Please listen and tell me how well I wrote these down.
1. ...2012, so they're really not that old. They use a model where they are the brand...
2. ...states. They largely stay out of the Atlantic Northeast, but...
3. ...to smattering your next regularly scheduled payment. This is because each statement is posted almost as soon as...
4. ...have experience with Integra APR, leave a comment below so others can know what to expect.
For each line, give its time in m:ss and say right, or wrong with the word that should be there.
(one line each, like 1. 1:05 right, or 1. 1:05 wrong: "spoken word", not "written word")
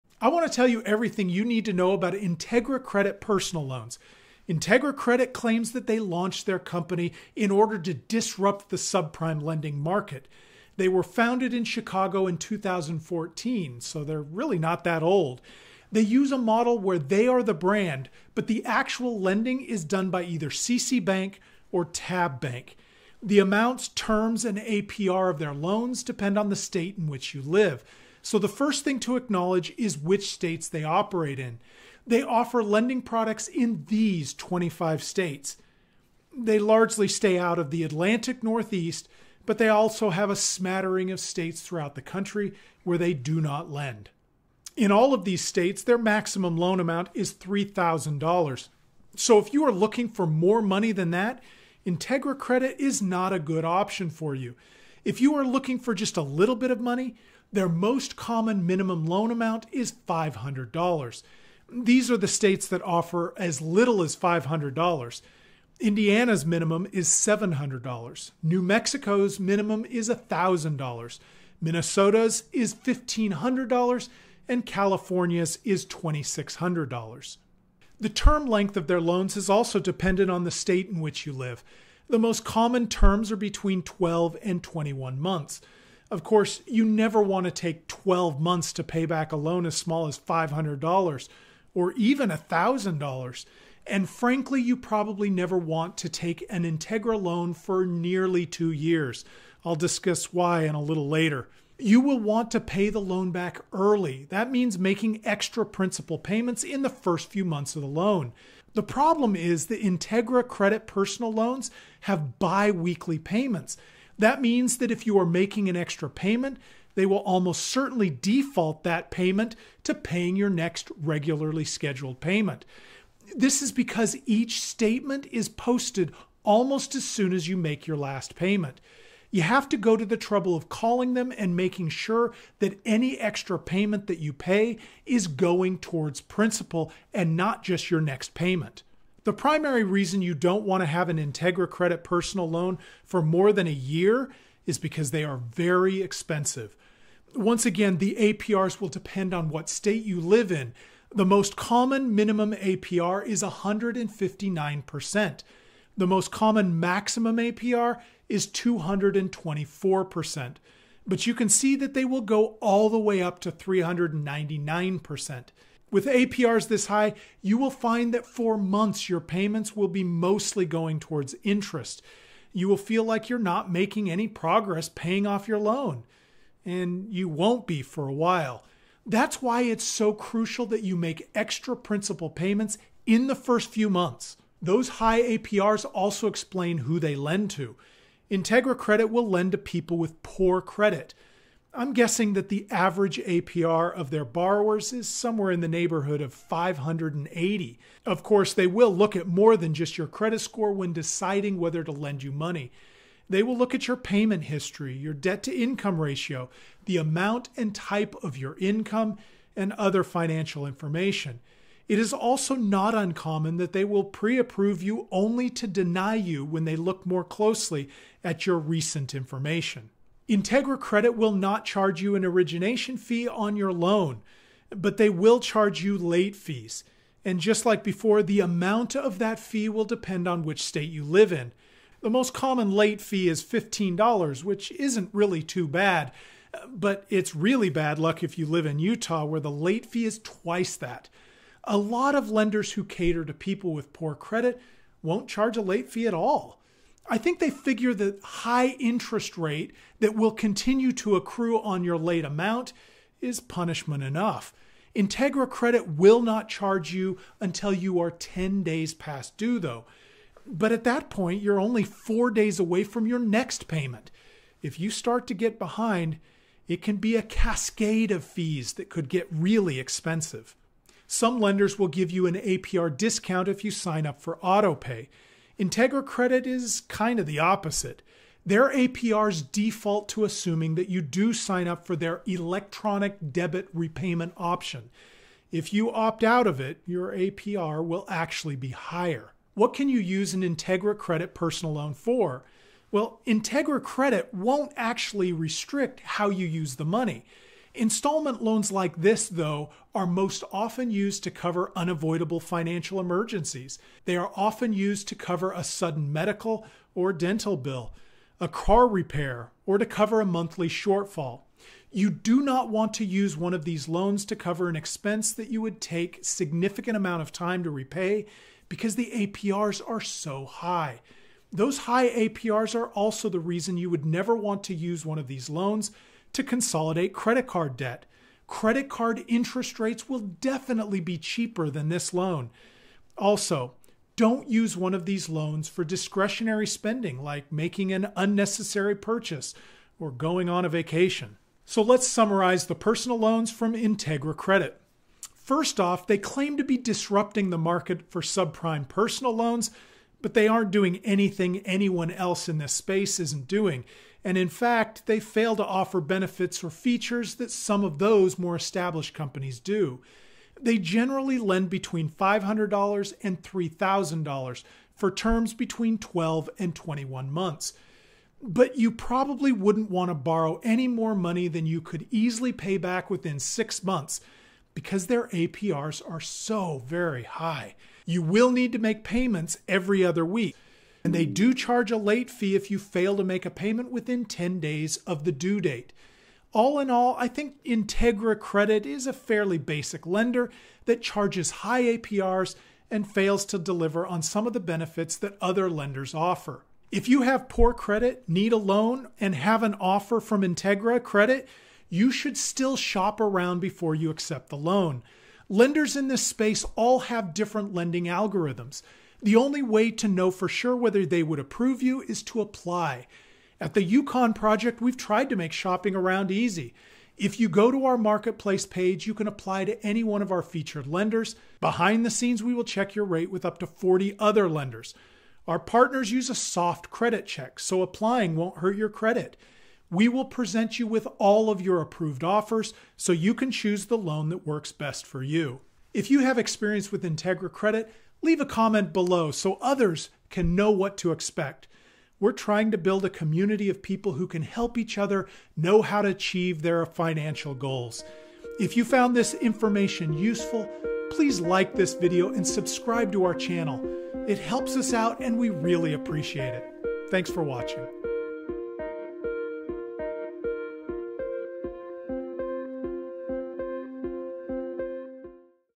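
1. 0:12 wrong: "2014", not "2012"
2. 0:35 right
3. 1:59 wrong: "paying", not "smattering"
4. 7:16 wrong: "Credit", not "APR".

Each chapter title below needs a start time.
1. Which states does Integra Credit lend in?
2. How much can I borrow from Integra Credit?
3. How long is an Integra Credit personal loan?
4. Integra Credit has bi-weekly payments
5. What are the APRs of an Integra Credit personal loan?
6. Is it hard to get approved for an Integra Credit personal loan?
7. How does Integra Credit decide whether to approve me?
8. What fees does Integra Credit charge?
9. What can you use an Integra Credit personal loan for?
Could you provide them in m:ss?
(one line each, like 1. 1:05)
1. 0:23
2. 0:44
3. 1:17
4. 1:48
5. 2:19
6. 3:04
7. 3:23
8. 3:40
9. 4:49.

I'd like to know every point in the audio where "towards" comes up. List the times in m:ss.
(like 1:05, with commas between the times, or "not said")
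2:15, 2:51.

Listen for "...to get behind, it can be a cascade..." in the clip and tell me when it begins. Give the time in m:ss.
4:25.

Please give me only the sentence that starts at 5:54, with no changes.
And in fact, they fail to offer benefits or features that some of those more established companies do.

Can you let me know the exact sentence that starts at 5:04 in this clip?
They are often used to cover a sudden medical or dental bill, a car repair, or to cover a monthly shortfall.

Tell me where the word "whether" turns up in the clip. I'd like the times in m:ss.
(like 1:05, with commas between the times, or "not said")
3:21, 6:50.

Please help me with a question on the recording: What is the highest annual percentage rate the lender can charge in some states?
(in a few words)
399%.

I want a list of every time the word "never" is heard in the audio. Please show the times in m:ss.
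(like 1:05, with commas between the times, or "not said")
1:26, 1:35, 5:24.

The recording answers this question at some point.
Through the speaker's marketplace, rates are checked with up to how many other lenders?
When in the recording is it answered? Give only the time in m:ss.
7:03.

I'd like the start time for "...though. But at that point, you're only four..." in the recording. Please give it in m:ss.
4:19.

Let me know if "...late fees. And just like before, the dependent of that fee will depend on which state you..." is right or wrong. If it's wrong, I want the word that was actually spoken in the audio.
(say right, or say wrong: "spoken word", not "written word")
wrong: "amount", not "dependent".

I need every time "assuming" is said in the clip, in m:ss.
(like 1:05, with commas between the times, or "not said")
4:40.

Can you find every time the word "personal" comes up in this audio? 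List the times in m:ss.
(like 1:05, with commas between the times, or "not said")
0:03, 1:50, 2:22, 4:51, 5:42, 5:48.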